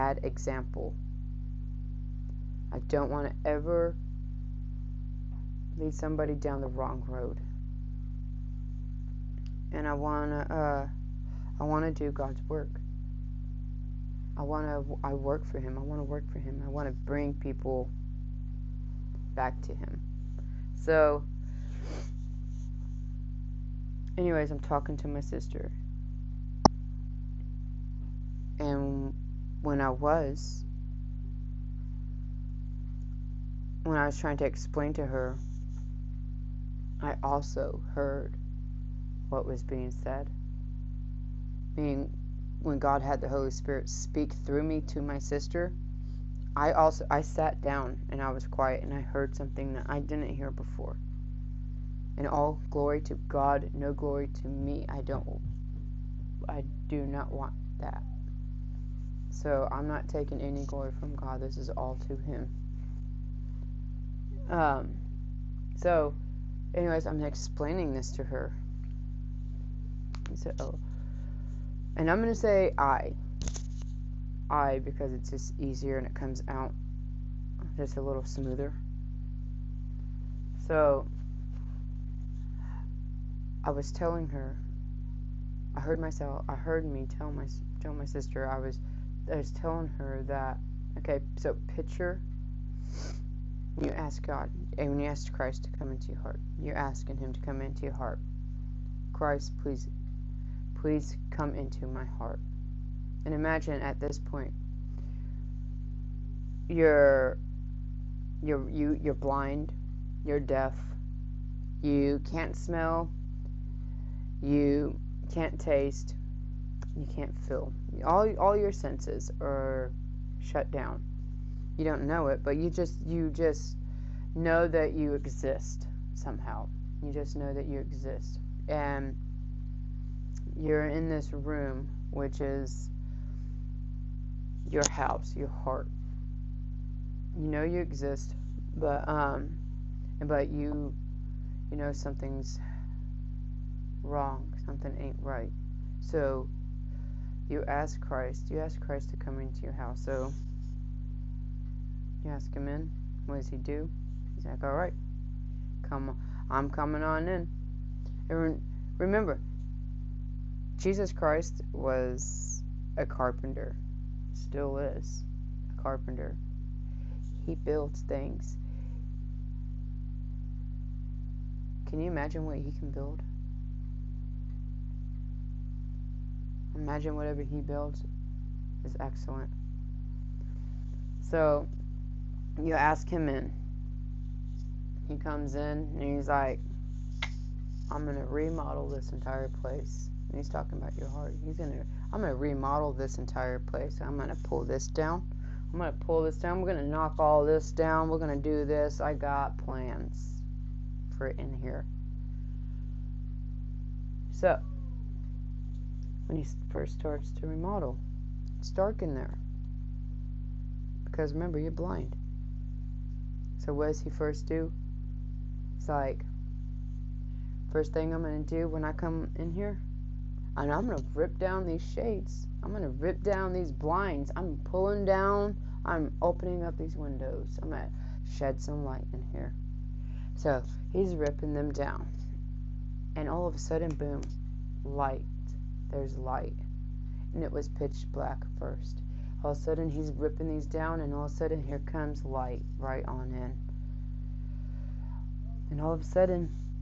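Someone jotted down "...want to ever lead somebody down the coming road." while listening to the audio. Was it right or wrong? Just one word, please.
wrong.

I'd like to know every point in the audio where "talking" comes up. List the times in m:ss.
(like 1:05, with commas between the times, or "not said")
0:24, 3:10.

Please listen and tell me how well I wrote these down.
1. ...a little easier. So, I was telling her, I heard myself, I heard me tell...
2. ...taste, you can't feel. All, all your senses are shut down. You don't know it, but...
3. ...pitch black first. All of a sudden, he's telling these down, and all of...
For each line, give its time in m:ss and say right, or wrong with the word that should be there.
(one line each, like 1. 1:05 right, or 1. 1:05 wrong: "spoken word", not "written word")
1. 1:17 wrong: "smoother", not "easier"
2. 1:55 right
3. 3:57 wrong: "ripping", not "telling".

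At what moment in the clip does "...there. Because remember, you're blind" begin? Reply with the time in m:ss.
3:29.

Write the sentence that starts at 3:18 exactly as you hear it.
I got plans for it in here.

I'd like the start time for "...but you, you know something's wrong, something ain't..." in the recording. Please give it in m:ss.
2:20.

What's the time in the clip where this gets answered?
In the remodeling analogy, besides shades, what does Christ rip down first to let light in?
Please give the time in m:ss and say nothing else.
3:43.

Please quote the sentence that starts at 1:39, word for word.
Christ, please, please come into my heart.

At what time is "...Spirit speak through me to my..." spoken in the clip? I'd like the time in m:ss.
0:43.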